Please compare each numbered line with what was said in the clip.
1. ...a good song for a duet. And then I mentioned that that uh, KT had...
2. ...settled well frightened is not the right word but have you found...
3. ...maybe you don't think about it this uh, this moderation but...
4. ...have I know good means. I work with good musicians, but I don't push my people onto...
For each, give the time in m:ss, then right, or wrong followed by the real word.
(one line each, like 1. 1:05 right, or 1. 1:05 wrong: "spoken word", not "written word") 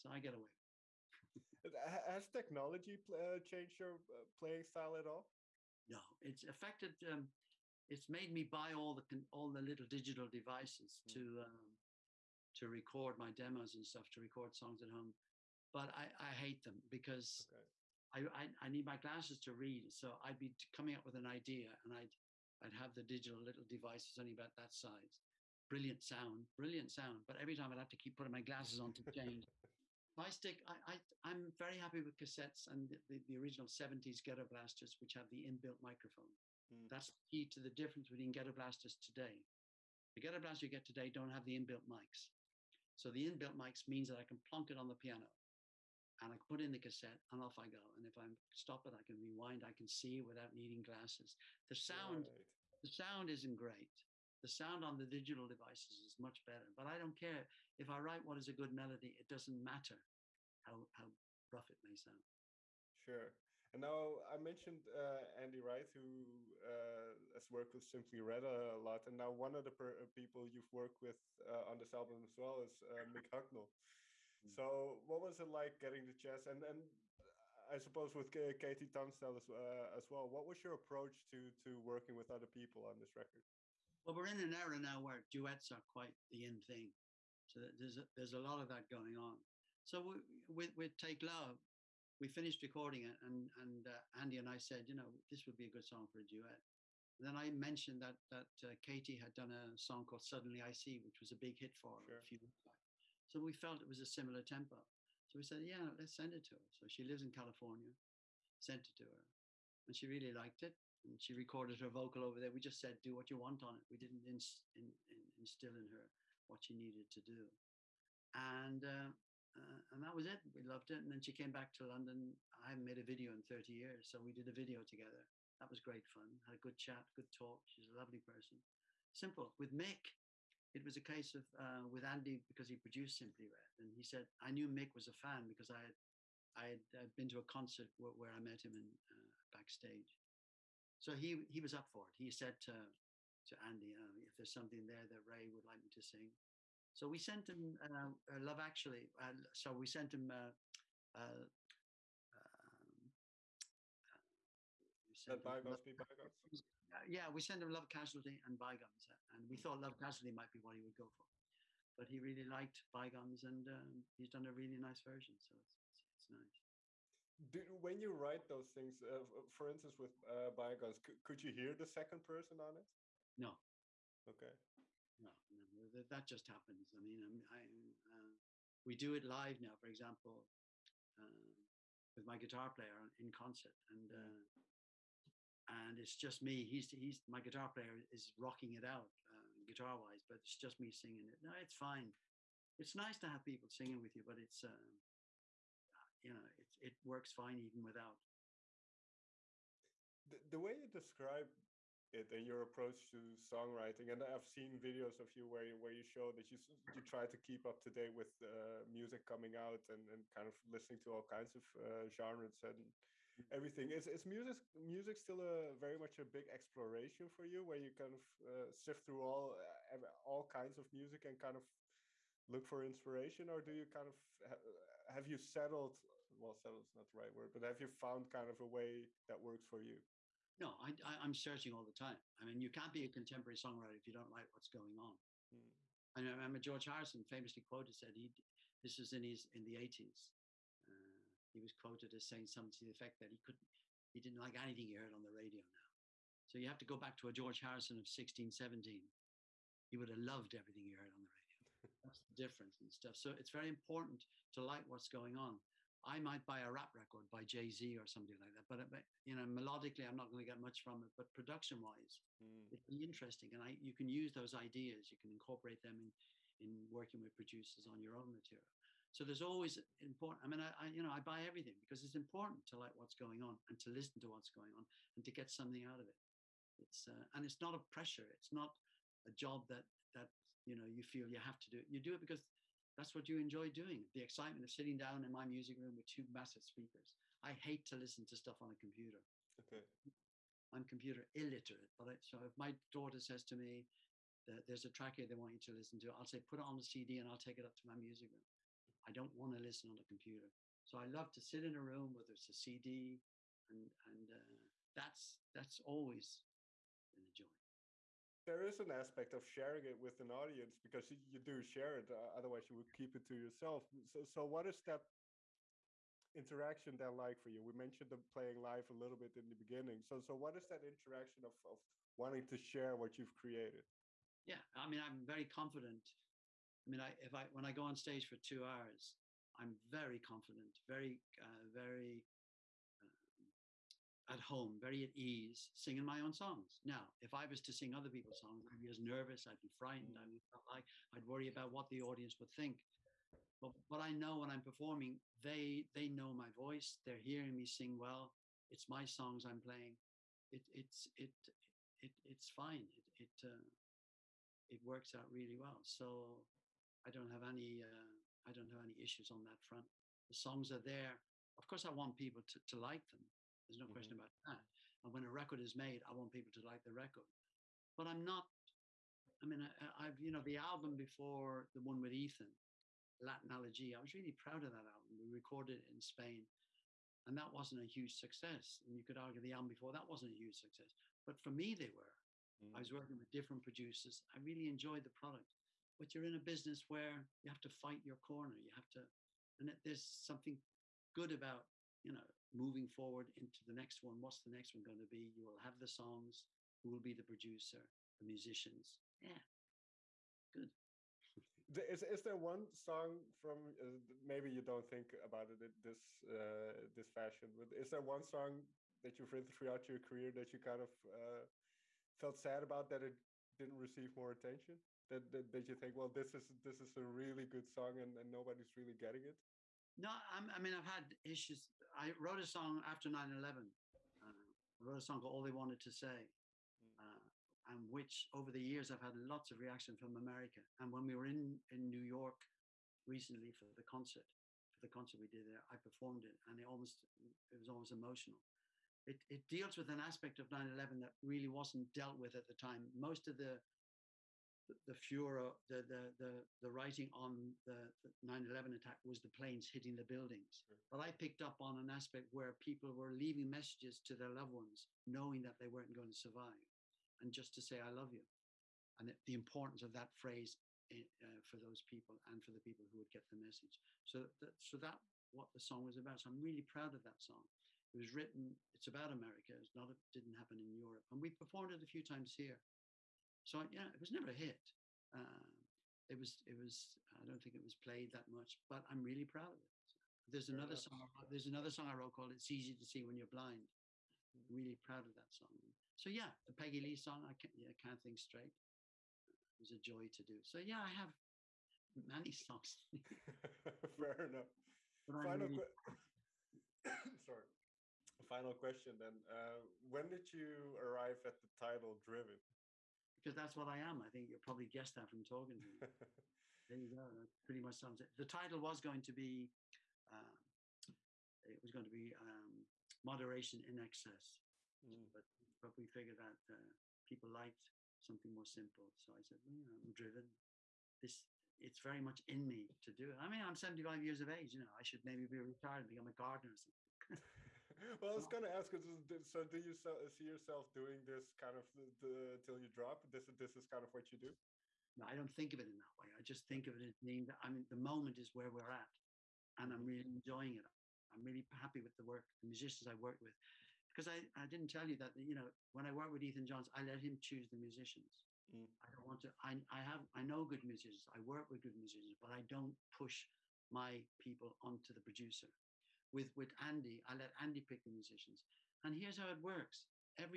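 1. 1:35 right
2. 3:45 wrong: "settled", not "frightened"
3. 6:44 wrong: "fashion", not "moderation"
4. 9:09 wrong: "musicians", not "means".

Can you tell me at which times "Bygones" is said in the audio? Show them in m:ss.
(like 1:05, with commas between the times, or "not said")
2:38, 2:42, 2:50.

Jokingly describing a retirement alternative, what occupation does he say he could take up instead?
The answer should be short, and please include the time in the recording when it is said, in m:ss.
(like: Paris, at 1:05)
gardener, at 8:46.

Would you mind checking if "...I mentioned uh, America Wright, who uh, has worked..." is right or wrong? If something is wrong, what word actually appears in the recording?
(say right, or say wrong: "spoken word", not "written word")
wrong: "Andy", not "America".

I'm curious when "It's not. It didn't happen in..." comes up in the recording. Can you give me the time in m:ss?
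7:49.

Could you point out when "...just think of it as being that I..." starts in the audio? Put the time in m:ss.
8:56.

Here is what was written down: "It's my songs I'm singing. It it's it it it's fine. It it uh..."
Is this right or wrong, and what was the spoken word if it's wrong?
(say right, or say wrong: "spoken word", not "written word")
wrong: "playing", not "singing".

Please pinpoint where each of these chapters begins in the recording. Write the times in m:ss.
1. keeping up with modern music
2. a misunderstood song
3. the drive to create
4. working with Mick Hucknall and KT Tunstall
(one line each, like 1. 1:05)
1. 3:18
2. 6:40
3. 8:11
4. 1:02.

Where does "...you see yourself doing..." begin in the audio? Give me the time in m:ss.
8:49.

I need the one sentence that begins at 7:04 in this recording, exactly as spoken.
Uh, I wrote a song called All They Wanted to Say, hmm.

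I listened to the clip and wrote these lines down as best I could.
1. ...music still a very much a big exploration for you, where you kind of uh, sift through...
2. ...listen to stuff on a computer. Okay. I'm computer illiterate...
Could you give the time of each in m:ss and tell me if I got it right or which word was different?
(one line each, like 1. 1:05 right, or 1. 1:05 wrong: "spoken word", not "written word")
1. 3:34 right
2. 4:47 right.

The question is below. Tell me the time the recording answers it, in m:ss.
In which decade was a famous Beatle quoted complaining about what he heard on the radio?
3:59.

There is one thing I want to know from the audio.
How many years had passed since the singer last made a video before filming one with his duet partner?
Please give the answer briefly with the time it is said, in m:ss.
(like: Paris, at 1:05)
30, at 2:03.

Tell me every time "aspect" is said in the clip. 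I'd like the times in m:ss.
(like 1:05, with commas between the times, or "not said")
5:08, 7:19, 7:31.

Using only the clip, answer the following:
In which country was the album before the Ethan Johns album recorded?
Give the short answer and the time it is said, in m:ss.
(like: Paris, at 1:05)
Spain, at 6:16.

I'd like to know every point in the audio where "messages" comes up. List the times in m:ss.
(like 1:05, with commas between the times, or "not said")
7:33, 7:43.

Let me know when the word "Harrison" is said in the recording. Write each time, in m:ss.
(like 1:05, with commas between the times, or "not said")
3:56, 4:07.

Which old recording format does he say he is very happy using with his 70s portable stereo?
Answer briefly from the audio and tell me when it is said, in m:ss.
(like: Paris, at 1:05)
cassettes, at 0:32.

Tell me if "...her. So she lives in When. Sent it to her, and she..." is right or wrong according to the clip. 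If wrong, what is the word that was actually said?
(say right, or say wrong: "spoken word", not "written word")
wrong: "California", not "When".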